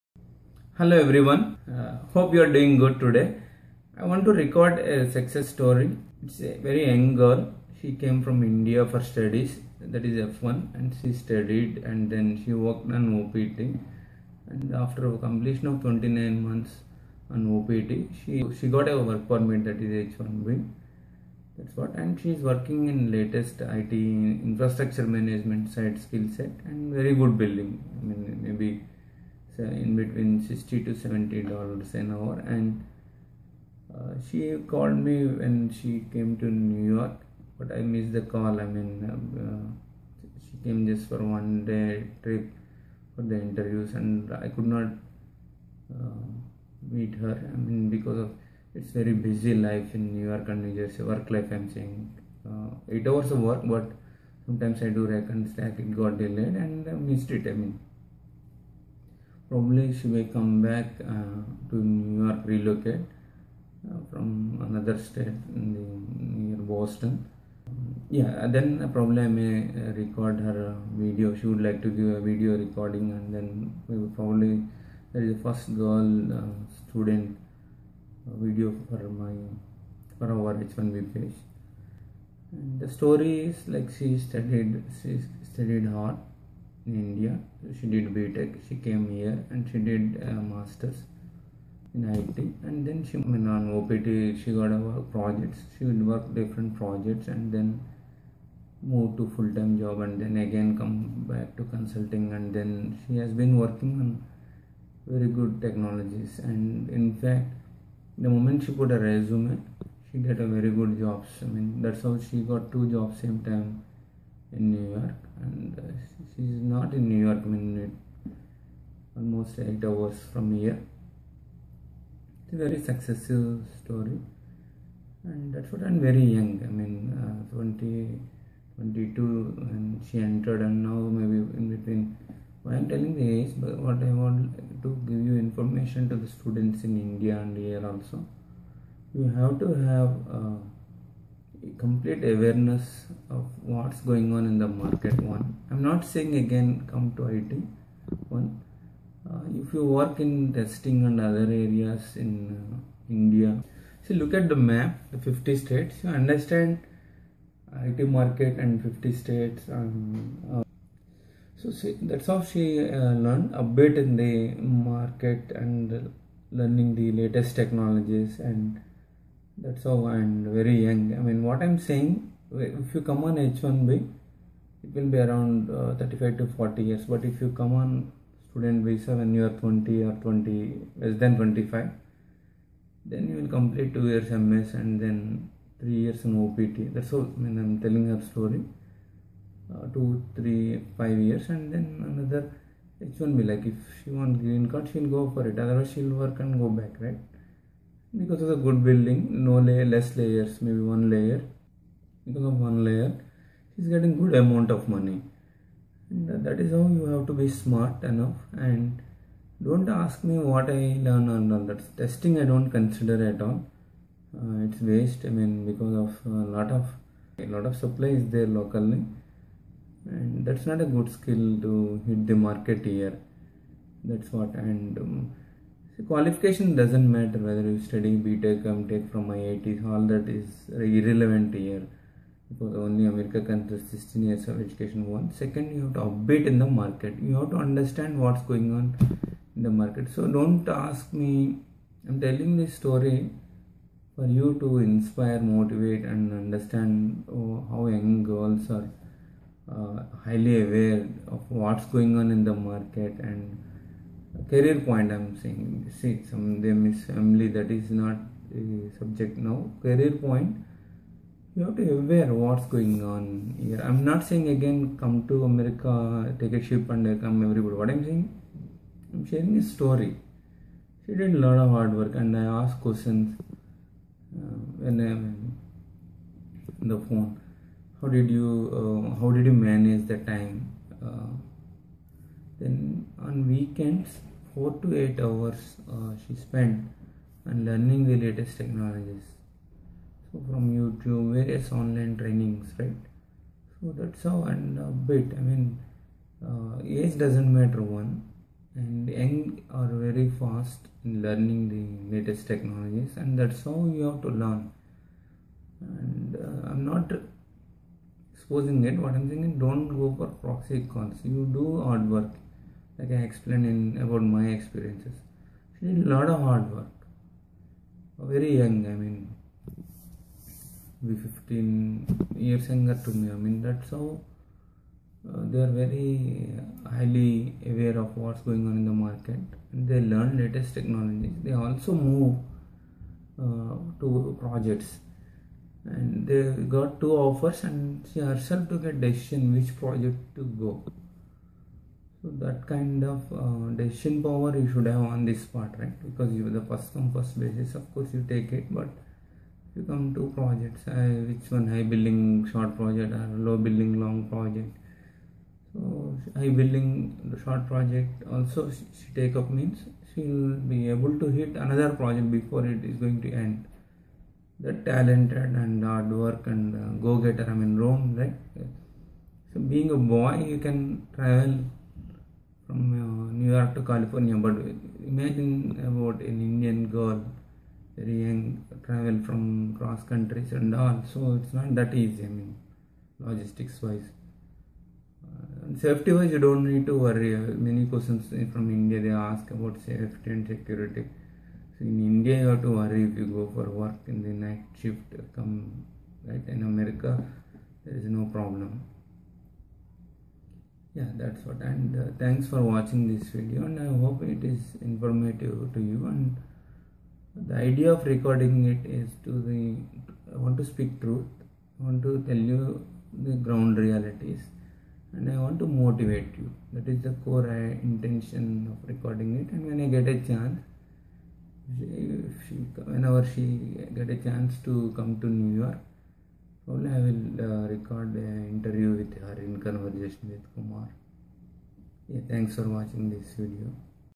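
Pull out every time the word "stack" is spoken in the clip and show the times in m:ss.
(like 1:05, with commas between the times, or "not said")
0:55.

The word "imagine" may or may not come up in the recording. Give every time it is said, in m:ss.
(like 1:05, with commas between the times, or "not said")
6:15.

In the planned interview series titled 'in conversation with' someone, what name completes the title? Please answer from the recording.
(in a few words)
Kumar.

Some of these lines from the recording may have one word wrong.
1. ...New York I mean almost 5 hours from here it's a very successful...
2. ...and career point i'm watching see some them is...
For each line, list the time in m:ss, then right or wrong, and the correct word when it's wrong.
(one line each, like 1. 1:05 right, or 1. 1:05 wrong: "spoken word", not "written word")
1. 1:57 wrong: "8", not "5"
2. 4:13 wrong: "saying", not "watching".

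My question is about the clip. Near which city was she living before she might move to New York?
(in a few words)
Boston.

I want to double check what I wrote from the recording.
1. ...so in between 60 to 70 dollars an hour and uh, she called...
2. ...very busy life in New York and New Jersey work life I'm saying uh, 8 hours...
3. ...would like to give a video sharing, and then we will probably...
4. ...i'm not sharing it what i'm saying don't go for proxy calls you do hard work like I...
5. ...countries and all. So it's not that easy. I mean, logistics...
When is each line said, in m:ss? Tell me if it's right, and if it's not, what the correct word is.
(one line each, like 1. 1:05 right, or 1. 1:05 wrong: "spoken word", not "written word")
1. 0:29 right
2. 0:48 right
3. 1:11 wrong: "recording", not "sharing"
4. 5:06 wrong: "exposing", not "sharing"
5. 6:20 right.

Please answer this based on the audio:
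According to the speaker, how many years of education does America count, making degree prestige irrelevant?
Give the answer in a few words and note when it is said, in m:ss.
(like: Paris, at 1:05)
16 years, at 3:53.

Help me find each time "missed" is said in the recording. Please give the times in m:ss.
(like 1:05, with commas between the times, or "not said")
0:37, 0:56.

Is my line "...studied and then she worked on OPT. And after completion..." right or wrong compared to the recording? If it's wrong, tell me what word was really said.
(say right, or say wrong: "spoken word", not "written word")
right.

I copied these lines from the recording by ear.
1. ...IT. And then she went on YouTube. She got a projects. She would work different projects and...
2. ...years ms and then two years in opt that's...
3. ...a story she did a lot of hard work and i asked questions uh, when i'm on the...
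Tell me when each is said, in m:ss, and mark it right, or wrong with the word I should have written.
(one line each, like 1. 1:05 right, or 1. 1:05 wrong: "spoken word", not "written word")
1. 1:32 wrong: "OPT", not "YouTube"
2. 3:04 wrong: "three", not "two"
3. 4:29 right.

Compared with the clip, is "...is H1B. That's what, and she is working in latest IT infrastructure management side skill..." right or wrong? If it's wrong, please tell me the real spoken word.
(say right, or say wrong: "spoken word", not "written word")
right.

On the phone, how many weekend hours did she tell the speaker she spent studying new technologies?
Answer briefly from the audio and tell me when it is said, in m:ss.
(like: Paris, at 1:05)
4 to 8 hours, at 4:44.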